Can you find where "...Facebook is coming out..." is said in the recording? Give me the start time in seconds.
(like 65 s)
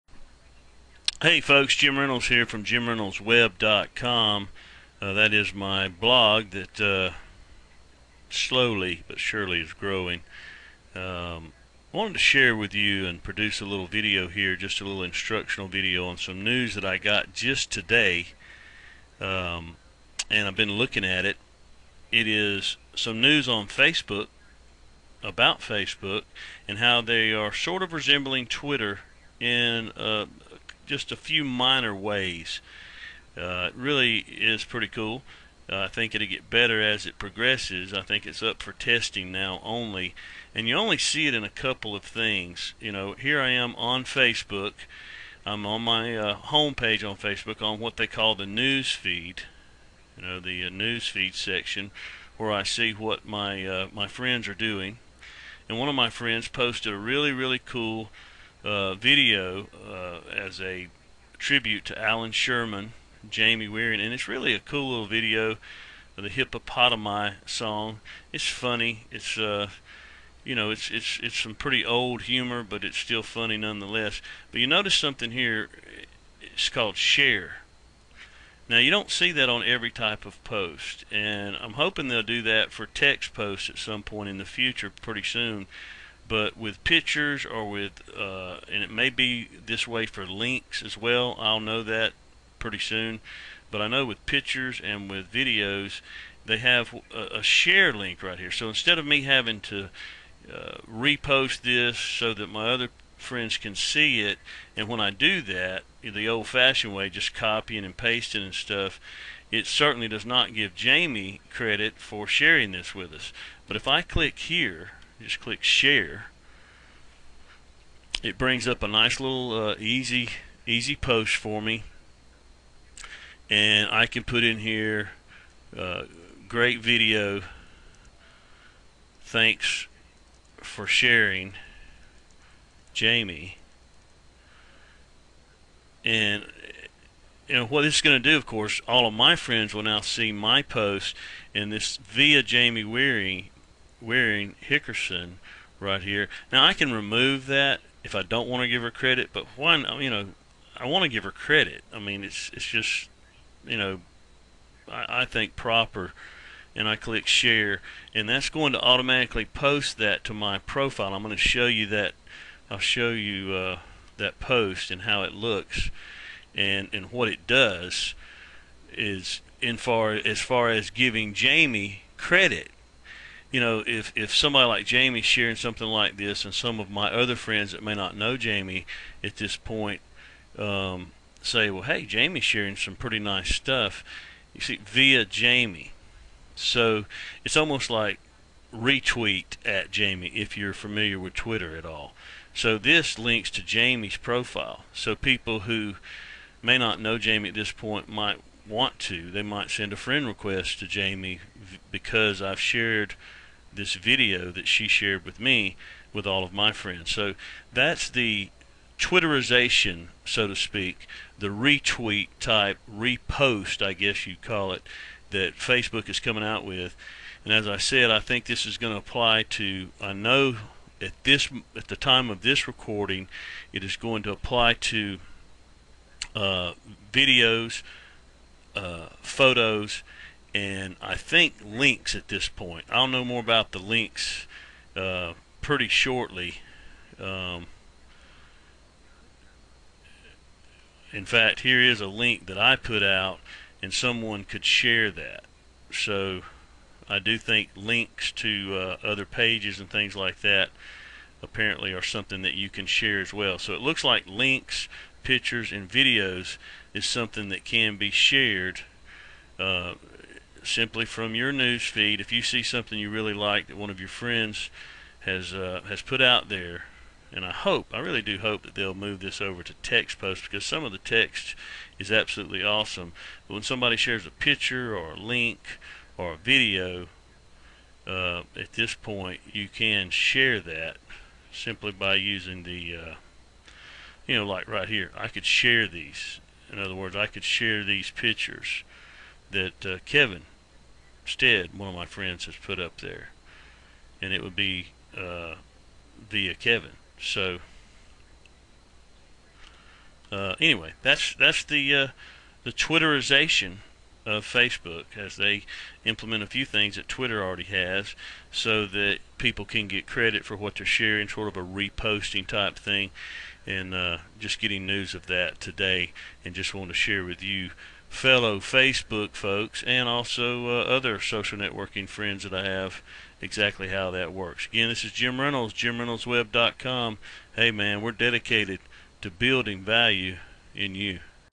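215 s.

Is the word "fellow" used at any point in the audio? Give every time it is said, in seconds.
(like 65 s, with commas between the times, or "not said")
318 s.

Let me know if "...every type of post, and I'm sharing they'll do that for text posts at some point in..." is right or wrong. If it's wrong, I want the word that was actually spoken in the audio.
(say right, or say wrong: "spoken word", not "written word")
wrong: "hoping", not "sharing".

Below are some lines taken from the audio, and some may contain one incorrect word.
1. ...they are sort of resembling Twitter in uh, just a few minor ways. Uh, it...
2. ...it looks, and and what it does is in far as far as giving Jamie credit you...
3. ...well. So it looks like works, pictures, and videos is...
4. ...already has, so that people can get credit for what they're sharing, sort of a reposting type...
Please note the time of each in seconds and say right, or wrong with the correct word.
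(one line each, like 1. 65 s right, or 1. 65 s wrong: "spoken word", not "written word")
1. 26 s right
2. 165 s right
3. 253 s wrong: "links", not "works"
4. 307 s right.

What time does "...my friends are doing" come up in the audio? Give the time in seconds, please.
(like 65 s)
53 s.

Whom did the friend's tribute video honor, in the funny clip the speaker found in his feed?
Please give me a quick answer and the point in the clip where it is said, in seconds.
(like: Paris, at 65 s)
Alan Sherman, at 62 s.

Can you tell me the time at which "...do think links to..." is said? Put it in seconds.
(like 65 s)
247 s.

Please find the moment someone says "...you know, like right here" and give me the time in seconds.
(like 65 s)
284 s.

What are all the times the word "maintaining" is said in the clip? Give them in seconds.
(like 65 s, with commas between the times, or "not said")
not said.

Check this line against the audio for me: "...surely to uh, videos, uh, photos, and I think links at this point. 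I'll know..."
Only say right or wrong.
wrong.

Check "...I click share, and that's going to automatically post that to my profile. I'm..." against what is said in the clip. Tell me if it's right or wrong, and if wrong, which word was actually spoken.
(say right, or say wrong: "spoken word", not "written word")
right.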